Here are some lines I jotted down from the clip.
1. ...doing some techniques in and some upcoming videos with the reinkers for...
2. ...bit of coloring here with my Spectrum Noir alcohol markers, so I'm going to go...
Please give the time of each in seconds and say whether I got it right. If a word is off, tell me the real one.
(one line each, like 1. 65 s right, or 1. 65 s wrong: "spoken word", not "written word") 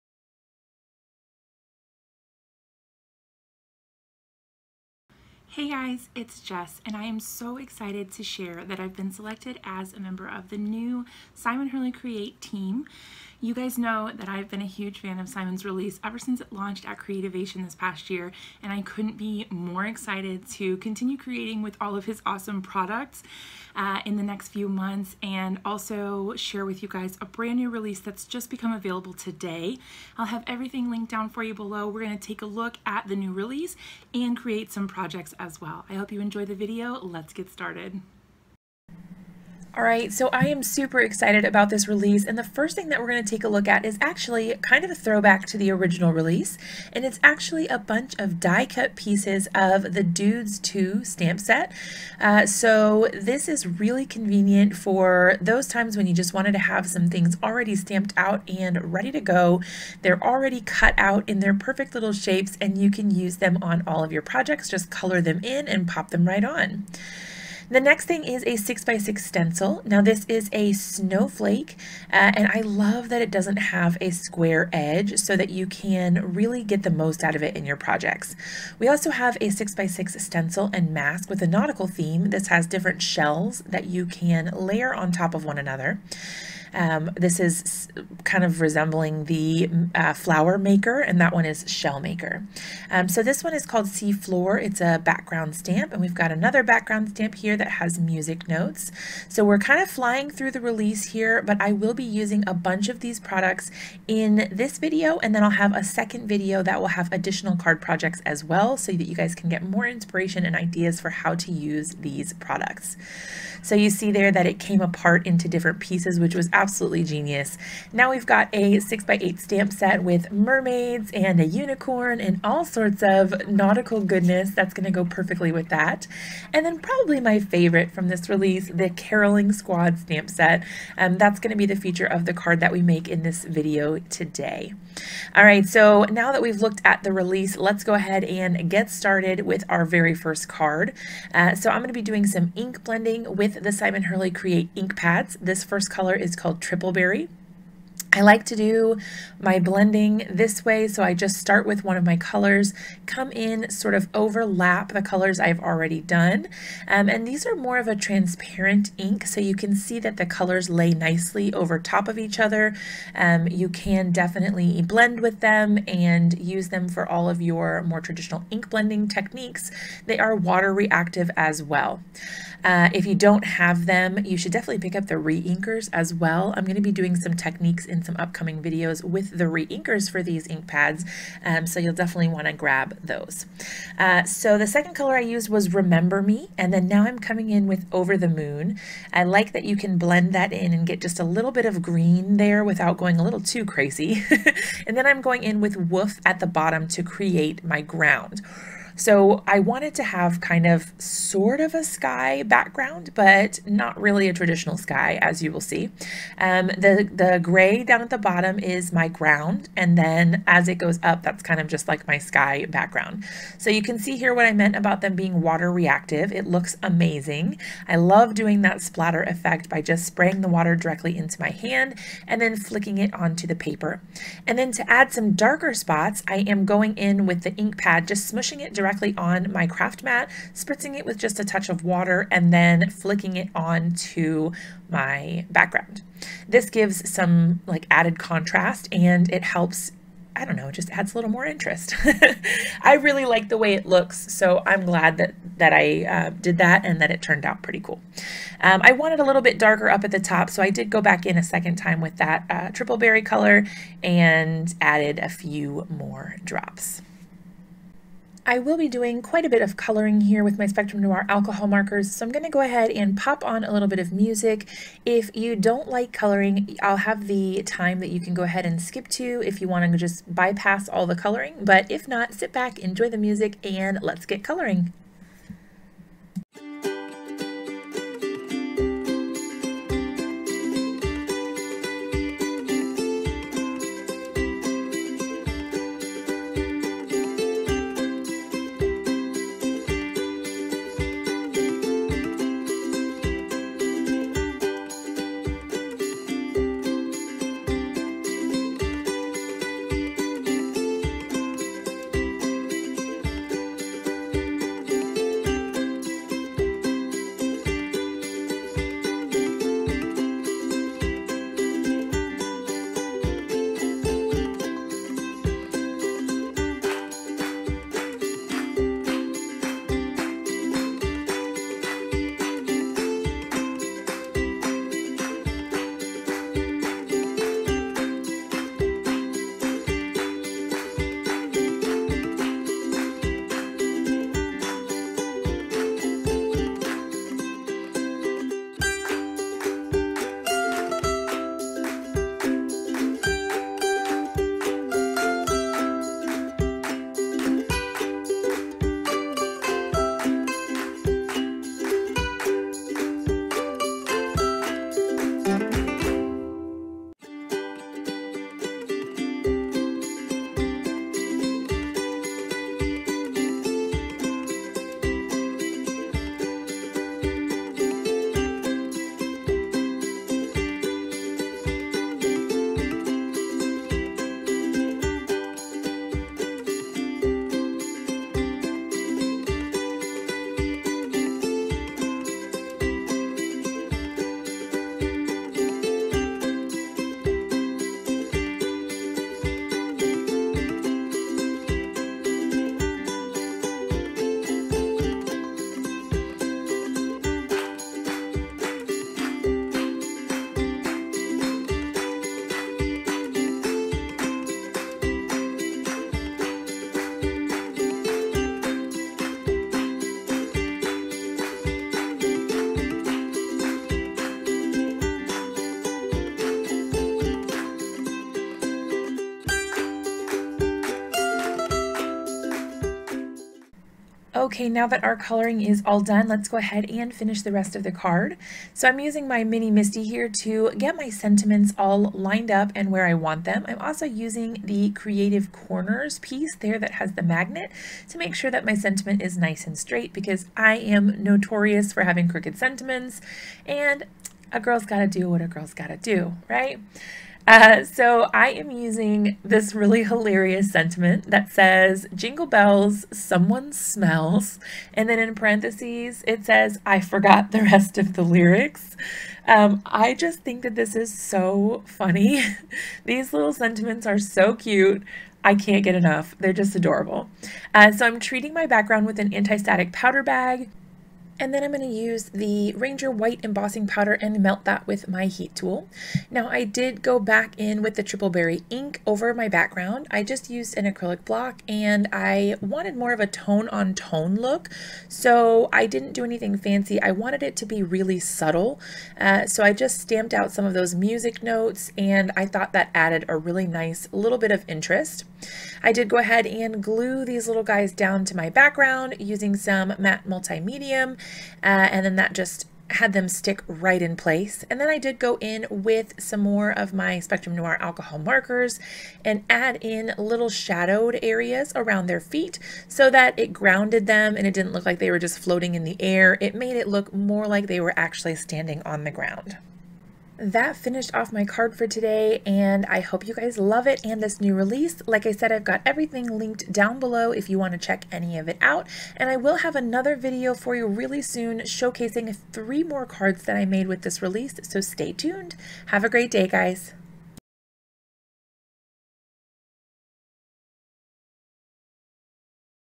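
1. 176 s right
2. 259 s right.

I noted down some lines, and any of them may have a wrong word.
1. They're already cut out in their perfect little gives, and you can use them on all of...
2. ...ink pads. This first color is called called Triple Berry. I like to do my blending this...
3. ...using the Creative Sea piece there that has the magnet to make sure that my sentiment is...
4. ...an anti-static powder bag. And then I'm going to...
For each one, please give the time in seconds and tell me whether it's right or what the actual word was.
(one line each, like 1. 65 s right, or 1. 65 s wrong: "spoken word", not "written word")
1. 60 s wrong: "shapes", not "gives"
2. 144 s right
3. 434 s wrong: "Corners", not "Sea"
4. 469 s right.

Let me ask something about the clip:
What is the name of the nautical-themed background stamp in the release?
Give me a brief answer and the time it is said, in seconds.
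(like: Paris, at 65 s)
Sea Floor, at 93 s.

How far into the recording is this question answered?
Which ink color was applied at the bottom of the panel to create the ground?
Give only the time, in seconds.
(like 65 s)
195 s.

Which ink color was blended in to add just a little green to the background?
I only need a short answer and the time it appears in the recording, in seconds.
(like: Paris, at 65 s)
Over the Moon, at 187 s.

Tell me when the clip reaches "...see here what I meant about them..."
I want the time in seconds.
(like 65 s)
213 s.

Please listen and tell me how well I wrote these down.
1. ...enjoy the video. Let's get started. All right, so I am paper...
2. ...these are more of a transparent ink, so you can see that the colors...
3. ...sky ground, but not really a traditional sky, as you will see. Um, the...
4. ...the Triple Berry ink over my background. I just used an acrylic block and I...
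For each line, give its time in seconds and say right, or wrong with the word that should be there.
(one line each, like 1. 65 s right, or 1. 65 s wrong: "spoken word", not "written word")
1. 36 s wrong: "super", not "paper"
2. 157 s right
3. 201 s wrong: "background", not "ground"
4. 477 s right.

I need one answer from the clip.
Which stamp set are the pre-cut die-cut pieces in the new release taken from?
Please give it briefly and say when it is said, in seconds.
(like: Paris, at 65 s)
Dudes 2, at 50 s.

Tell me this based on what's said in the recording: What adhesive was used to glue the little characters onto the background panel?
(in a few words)
matte multi-medium.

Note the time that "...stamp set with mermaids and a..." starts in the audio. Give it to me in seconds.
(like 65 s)
119 s.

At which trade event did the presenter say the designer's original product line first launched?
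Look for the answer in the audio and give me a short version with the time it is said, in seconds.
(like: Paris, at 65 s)
Creativation, at 16 s.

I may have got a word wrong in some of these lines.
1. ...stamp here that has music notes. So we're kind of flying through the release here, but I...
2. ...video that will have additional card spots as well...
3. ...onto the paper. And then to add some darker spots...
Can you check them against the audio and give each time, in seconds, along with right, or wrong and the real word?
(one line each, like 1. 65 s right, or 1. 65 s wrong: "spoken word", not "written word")
1. 97 s right
2. 106 s wrong: "projects", not "spots"
3. 223 s right.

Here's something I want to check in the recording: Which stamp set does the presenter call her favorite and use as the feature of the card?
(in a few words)
Caroling Squad.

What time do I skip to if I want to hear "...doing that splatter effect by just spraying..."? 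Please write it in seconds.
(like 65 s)
218 s.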